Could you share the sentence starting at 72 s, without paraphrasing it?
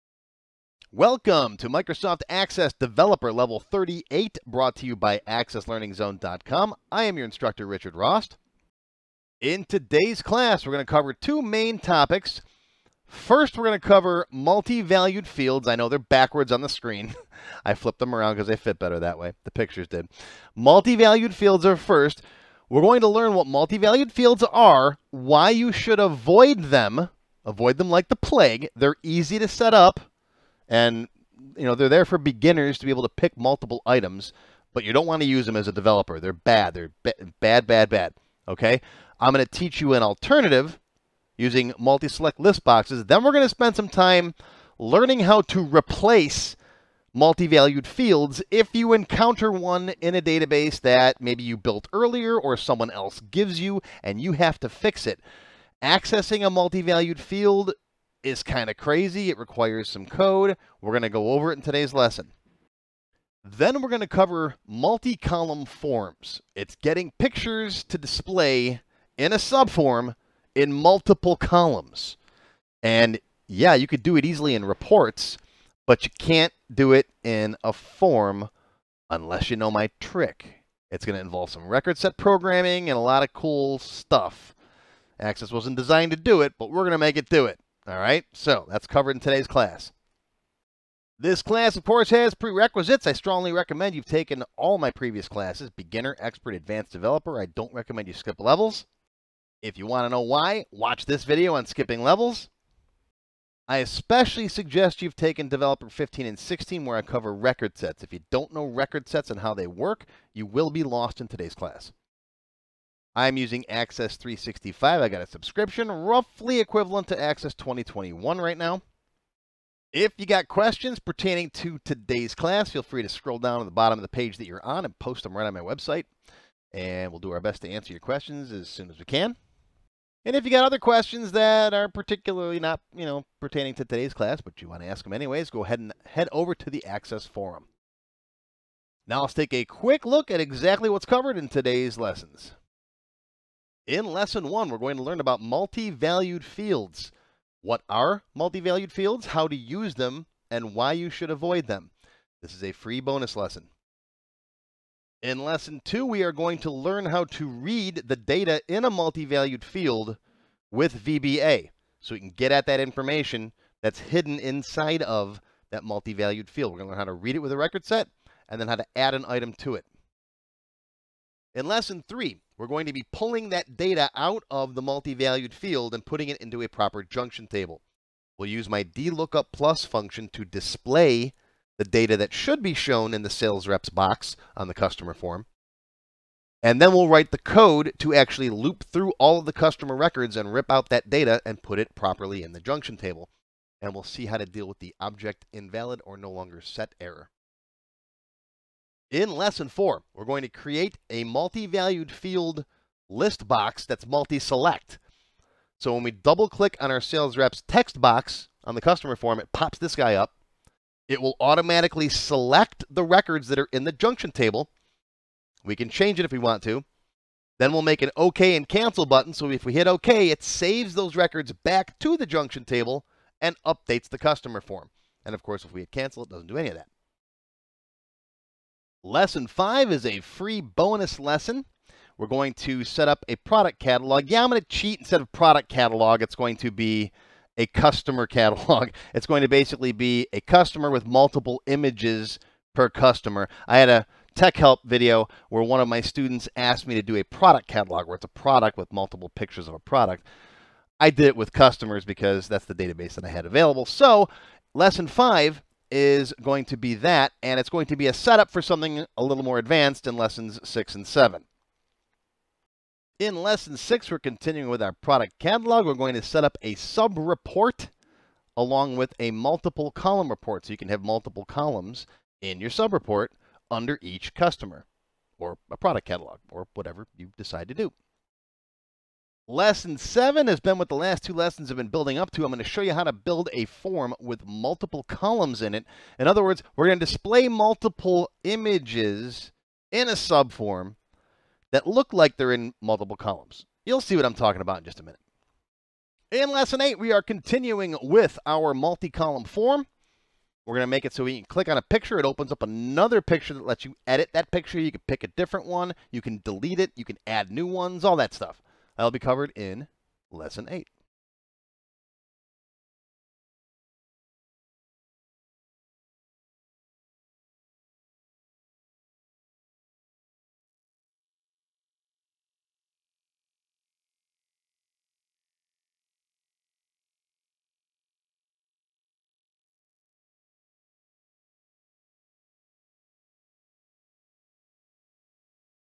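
And yeah, you could do it easily in reports, but you can't do it in a form unless you know my trick.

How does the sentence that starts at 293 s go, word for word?
You'll see what I'm talking about in just a minute.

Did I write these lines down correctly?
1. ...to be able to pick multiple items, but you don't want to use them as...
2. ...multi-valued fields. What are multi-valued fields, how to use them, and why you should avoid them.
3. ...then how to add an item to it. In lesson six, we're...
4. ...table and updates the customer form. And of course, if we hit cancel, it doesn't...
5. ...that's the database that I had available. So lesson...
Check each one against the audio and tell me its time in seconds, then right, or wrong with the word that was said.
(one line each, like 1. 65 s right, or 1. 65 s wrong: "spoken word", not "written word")
1. 32 s right
2. 145 s right
3. 168 s wrong: "three", not "six"
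4. 222 s right
5. 252 s right.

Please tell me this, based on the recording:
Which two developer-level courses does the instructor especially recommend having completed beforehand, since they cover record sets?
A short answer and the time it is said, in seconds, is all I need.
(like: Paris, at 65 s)
Developer 15 and 16, at 105 s.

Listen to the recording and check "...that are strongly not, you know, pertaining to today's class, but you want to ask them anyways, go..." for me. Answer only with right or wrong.
wrong.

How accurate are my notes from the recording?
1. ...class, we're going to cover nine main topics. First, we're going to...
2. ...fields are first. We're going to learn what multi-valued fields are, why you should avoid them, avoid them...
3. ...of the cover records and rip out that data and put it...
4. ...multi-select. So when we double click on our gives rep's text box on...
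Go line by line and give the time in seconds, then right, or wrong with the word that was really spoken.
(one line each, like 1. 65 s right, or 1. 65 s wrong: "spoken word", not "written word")
1. 10 s wrong: "two", not "nine"
2. 21 s right
3. 189 s wrong: "customer", not "cover"
4. 204 s wrong: "sales", not "gives".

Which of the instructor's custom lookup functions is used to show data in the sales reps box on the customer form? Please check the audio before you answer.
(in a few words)
DLOOKUP plus.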